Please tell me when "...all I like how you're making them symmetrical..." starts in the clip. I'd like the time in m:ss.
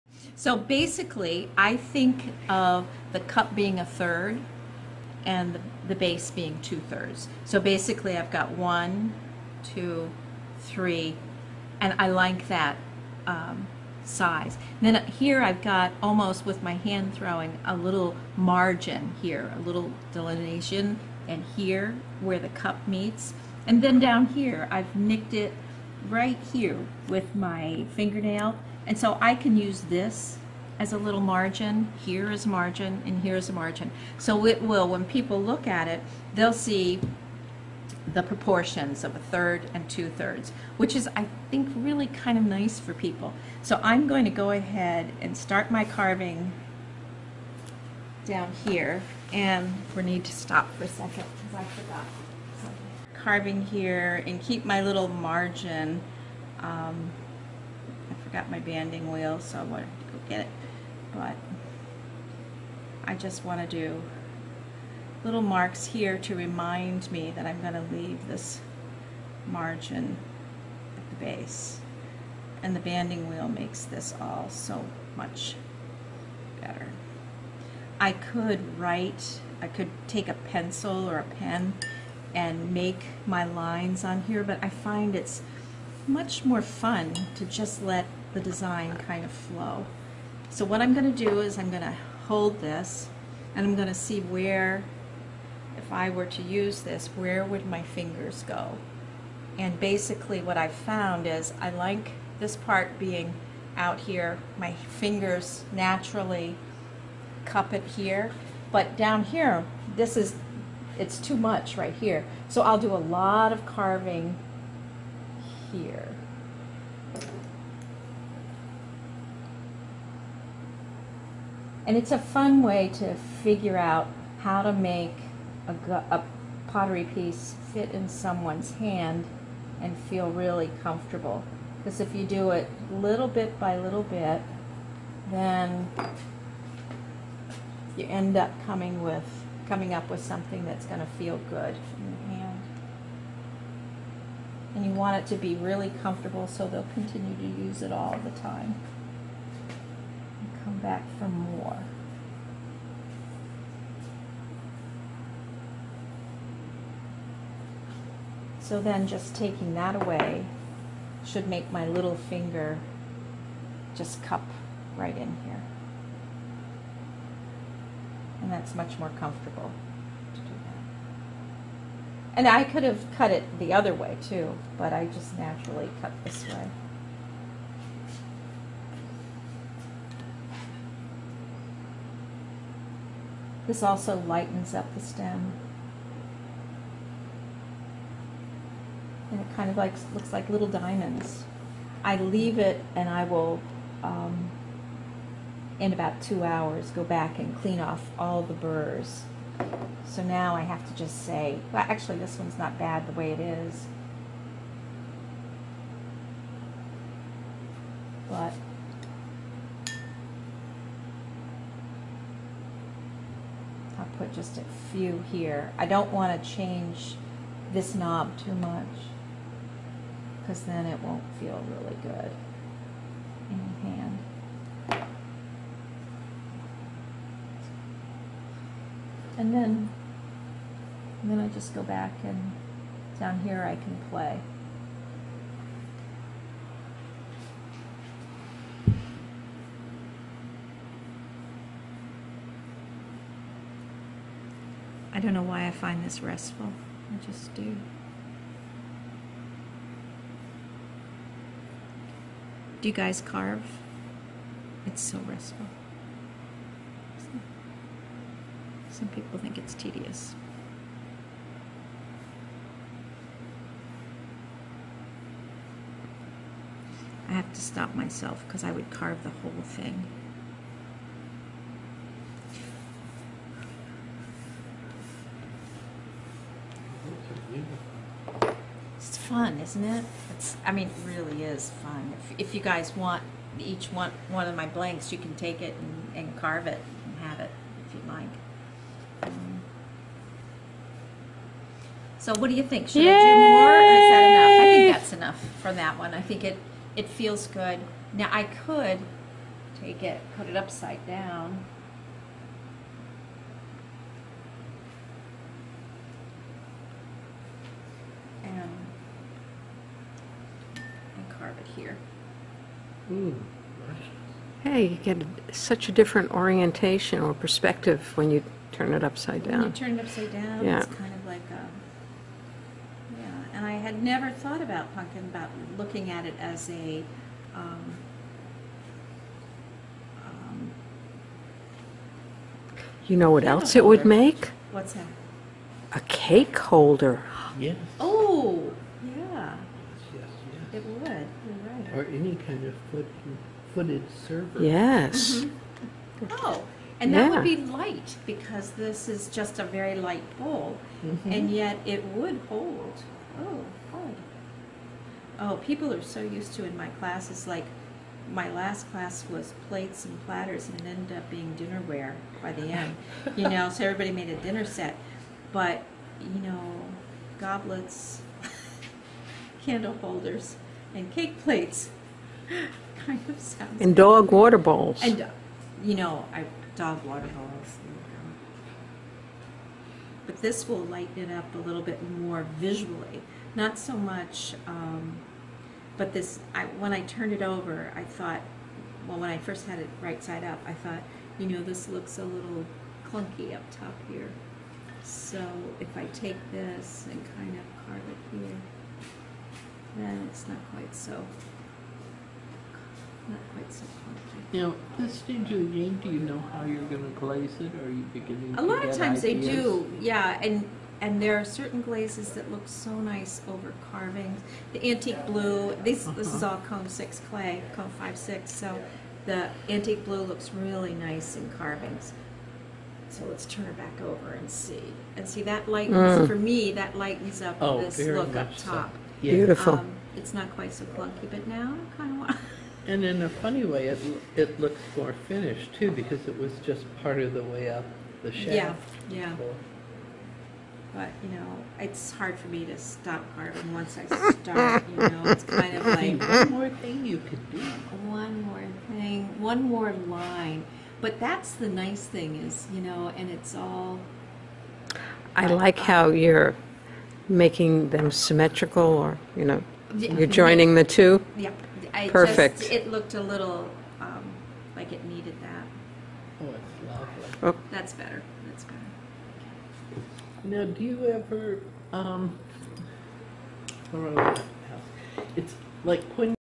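7:33.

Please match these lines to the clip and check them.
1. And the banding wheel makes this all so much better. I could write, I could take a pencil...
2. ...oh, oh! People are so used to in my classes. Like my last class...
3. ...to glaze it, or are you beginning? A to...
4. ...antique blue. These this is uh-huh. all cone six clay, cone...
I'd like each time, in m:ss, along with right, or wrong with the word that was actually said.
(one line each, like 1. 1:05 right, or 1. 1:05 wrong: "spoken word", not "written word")
1. 1:12 right
2. 5:53 right
3. 6:47 right
4. 6:54 right.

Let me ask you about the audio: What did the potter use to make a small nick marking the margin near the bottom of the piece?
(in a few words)
Fingernail.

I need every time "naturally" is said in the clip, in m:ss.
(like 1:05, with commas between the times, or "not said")
1:45, 2:55.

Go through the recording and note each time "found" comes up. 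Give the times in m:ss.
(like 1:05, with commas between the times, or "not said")
1:40.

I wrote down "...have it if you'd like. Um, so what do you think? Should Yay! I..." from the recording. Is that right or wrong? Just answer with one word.
right.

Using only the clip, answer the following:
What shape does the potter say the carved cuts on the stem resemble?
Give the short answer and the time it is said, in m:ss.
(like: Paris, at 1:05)
Little diamonds, at 3:10.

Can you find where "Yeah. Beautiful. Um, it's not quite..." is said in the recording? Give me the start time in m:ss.
7:09.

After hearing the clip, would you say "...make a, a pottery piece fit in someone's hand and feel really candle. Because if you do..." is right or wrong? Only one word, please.
wrong.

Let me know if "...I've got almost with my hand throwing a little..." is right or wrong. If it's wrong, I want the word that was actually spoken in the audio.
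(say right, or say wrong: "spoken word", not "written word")
right.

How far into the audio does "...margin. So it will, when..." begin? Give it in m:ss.
0:33.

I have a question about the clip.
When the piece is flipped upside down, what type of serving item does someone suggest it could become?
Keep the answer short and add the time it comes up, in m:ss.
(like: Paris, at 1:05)
A cake holder, at 5:35.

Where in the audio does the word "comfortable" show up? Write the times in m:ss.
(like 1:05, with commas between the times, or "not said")
2:10, 2:26, 2:49.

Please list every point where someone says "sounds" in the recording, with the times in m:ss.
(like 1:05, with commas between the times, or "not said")
6:13.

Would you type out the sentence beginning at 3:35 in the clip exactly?
I don't want to change this knob too much because then it won't feel really good in your hand.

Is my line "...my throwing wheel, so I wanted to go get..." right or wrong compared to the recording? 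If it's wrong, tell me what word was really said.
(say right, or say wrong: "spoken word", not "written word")
wrong: "banding", not "throwing".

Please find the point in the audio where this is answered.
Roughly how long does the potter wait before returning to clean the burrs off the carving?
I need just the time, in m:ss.
3:16.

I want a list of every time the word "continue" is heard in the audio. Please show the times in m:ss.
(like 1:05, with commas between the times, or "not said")
2:26.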